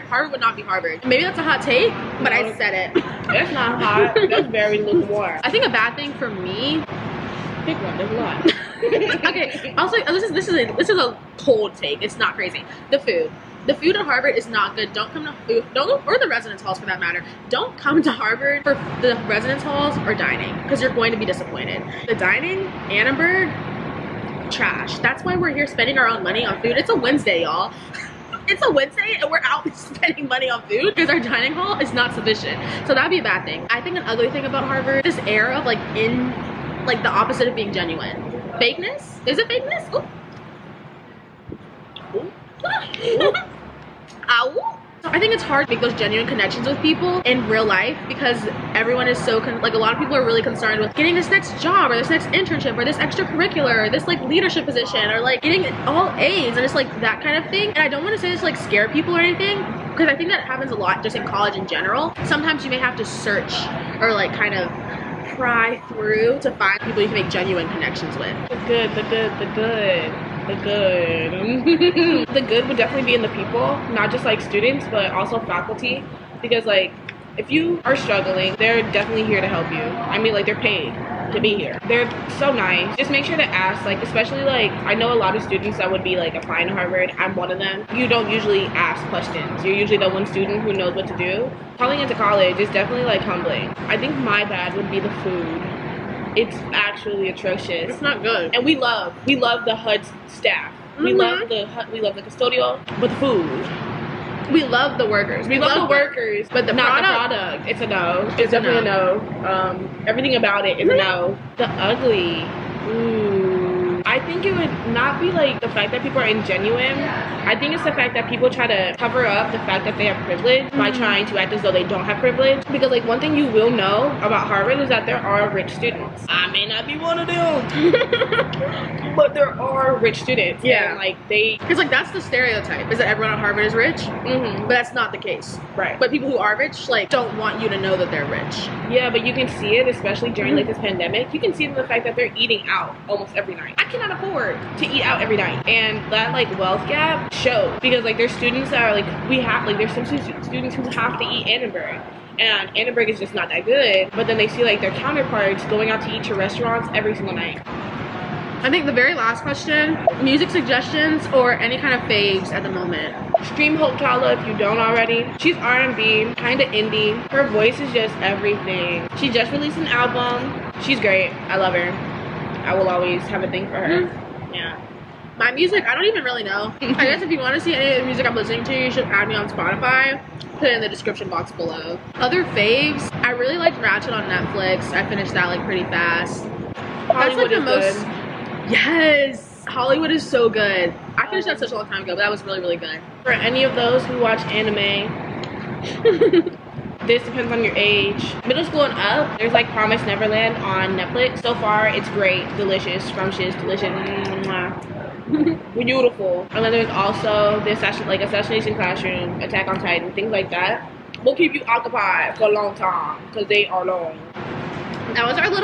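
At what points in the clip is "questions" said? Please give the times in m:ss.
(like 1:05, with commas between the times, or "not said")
1:29, 2:39.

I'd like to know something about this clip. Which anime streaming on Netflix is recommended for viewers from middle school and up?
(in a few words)
Promise Neverland.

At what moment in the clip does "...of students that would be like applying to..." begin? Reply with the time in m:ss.
1:25.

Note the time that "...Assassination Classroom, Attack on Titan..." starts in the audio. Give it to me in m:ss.
3:28.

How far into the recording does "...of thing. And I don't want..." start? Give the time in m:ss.
0:57.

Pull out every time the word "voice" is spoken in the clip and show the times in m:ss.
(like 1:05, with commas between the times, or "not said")
2:47.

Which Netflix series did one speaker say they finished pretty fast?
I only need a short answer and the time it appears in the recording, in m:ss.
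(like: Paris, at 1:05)
Ratched, at 3:03.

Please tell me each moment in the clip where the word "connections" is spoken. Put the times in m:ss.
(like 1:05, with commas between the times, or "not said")
0:46, 1:07.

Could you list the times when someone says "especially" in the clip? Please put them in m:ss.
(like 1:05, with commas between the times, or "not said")
1:24, 2:19.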